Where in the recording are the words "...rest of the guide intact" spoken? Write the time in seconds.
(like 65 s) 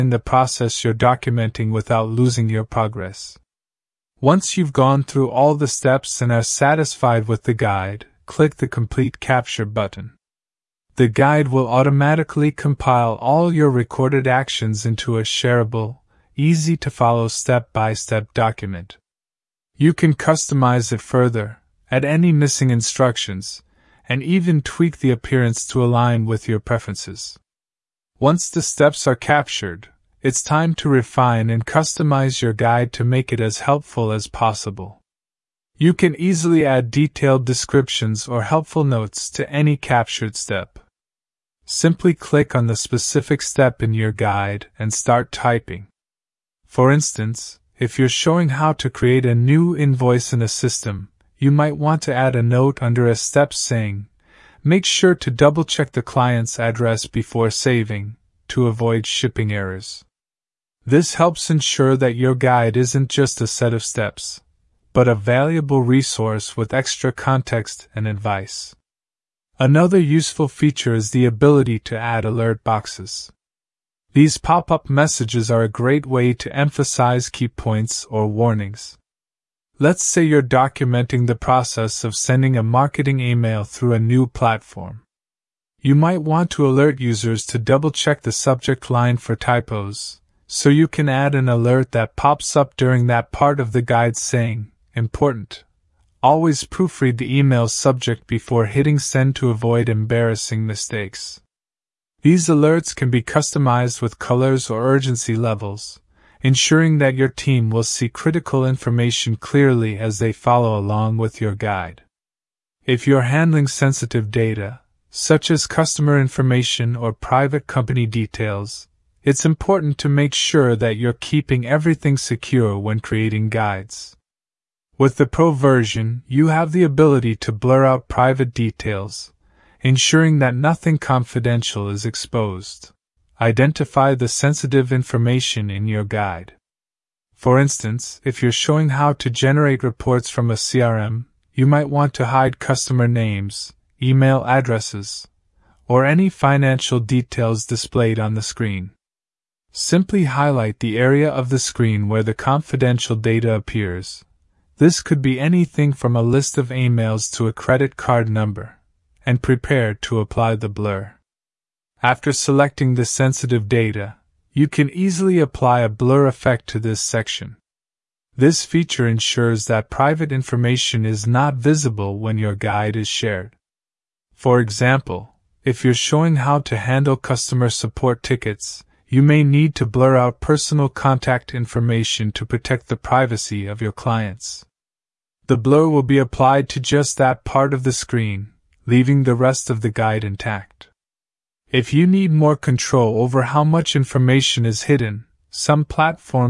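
189 s.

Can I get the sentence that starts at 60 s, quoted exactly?
This helps ensure that your guide isn't just a set of steps, but a valuable resource with extra context and advice.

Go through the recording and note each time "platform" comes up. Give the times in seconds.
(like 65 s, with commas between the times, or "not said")
84 s, 195 s.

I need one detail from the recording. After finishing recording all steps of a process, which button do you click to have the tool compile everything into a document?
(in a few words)
Complete Capture.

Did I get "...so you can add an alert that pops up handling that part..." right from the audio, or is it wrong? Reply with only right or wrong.
wrong.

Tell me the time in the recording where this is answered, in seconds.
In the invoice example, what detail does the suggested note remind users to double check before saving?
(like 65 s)
56 s.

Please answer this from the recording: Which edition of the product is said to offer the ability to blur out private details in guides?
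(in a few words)
Pro version.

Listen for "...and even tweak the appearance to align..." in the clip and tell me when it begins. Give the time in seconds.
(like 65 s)
24 s.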